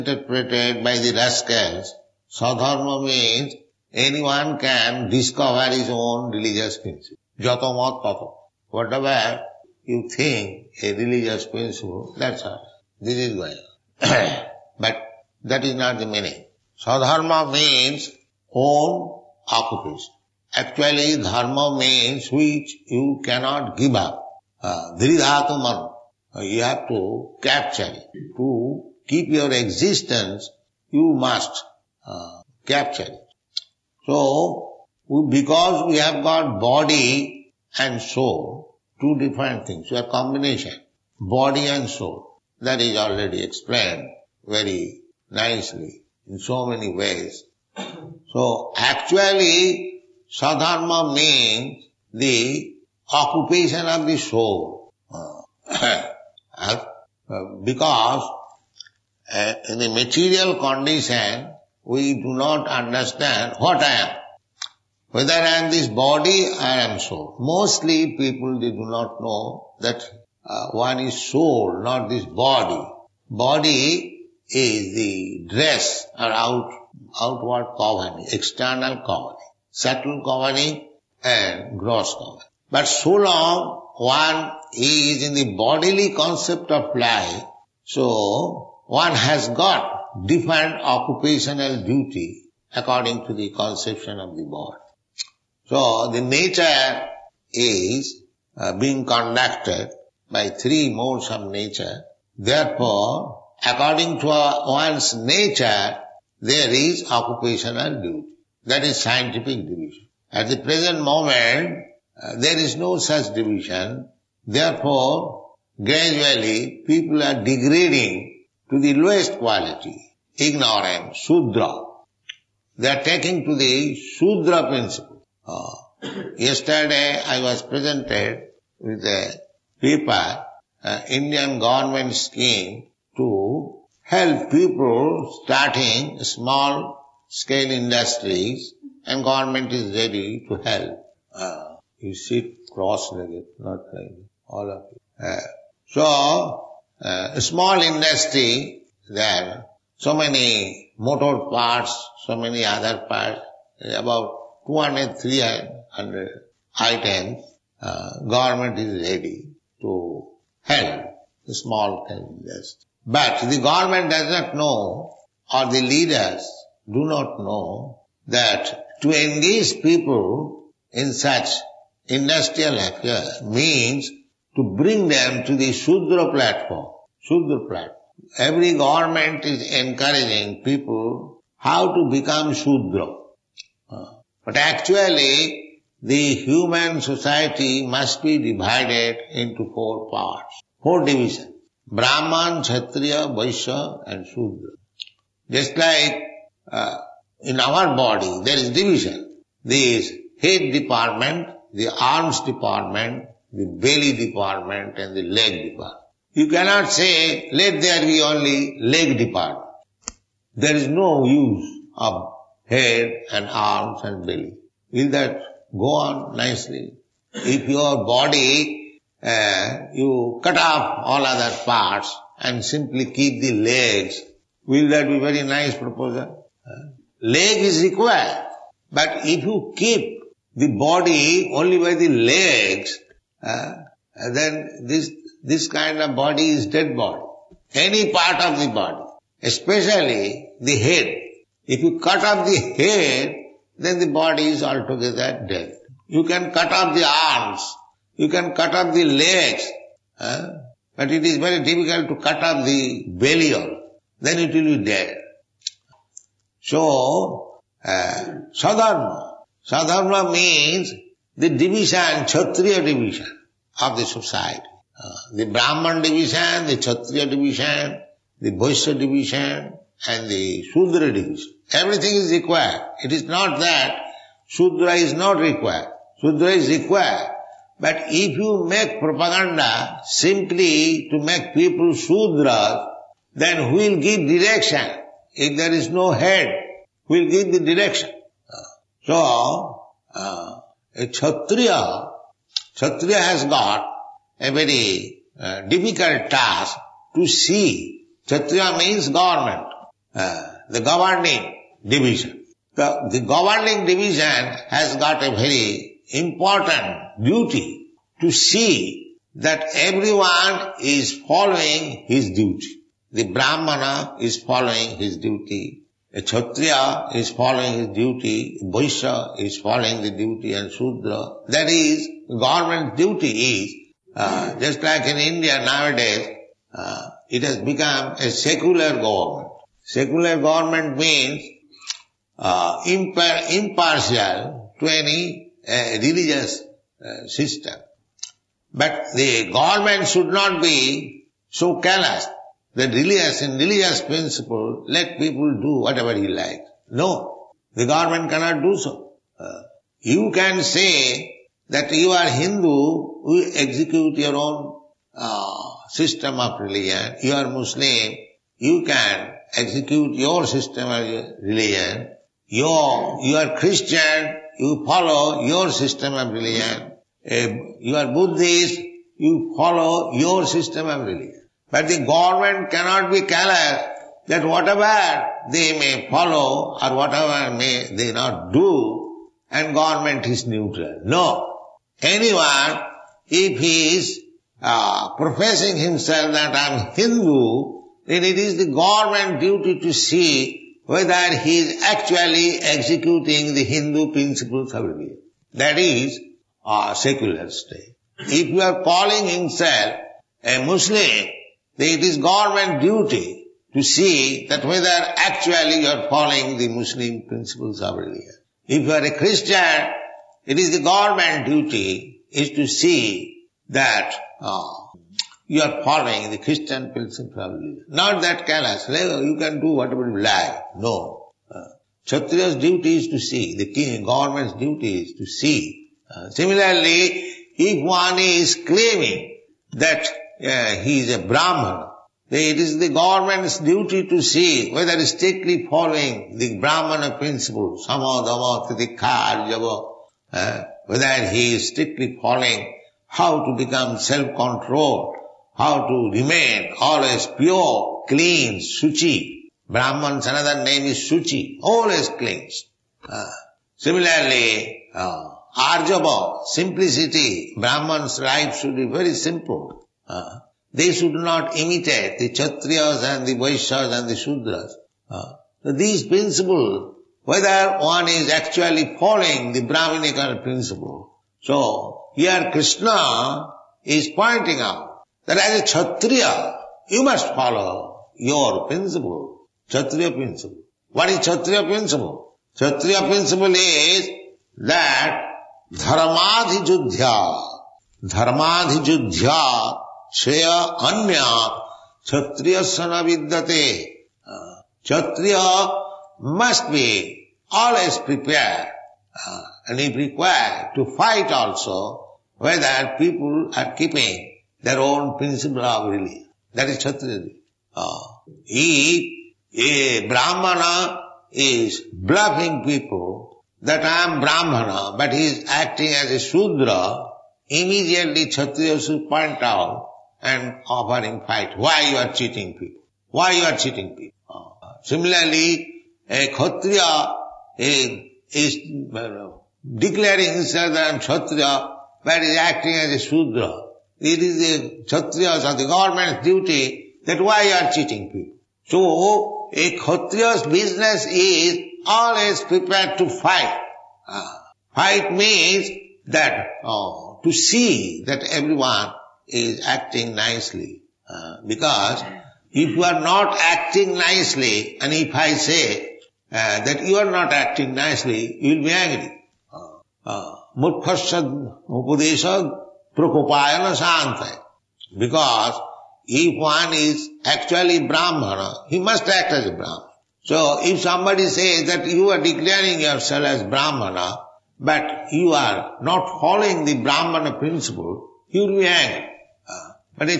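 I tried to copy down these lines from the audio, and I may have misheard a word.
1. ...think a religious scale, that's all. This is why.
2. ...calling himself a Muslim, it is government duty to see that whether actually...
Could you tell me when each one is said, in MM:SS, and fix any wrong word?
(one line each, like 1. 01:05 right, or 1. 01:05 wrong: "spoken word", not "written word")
1. 00:10 wrong: "principle", not "scale"
2. 06:38 right.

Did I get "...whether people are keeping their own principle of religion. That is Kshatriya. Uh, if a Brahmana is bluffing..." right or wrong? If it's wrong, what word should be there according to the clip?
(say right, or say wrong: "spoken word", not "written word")
right.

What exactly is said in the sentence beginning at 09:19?
Uh, uh, Murkhasad Because if one is actually Brahmana, he must act as a Brahmana.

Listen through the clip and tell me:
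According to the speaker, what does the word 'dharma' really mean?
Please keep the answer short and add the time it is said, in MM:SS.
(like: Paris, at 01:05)
Which you cannot give up, at 00:22.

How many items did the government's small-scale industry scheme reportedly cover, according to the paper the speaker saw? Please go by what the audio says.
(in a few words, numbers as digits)
200 to 300.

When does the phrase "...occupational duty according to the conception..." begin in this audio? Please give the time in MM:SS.
01:30.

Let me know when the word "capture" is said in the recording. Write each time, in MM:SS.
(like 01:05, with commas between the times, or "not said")
00:27, 00:32.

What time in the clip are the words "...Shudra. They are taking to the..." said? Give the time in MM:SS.
02:01.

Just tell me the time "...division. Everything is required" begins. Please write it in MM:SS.
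04:31.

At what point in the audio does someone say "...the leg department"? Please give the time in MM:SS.
03:25.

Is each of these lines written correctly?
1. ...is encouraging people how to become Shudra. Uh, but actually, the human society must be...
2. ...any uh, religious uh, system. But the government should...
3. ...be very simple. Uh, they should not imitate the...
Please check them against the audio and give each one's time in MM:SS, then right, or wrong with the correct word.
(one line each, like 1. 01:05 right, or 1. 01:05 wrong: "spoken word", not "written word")
1. 02:59 right
2. 05:34 right
3. 07:38 right.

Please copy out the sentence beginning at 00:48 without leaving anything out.
So, actually, sadharma means the occupation of the soul.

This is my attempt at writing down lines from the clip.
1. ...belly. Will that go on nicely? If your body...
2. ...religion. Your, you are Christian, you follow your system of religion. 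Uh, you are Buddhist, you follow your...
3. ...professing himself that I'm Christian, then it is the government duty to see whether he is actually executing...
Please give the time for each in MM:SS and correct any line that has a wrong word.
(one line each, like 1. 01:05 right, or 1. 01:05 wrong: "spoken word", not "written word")
1. 03:34 right
2. 06:01 right
3. 06:25 wrong: "Hindu", not "Christian".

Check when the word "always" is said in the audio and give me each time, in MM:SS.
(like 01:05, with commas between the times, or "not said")
07:26, 07:31, 08:17, 09:01.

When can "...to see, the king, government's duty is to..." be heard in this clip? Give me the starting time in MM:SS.
07:03.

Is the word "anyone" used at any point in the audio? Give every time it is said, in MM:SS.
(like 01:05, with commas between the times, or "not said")
00:03, 06:22.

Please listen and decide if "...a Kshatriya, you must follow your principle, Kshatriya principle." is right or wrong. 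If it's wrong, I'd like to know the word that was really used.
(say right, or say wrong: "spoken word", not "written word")
right.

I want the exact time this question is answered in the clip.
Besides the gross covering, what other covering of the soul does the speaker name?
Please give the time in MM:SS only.
01:19.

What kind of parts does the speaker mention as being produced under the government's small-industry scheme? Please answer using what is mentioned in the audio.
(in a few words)
Motor parts.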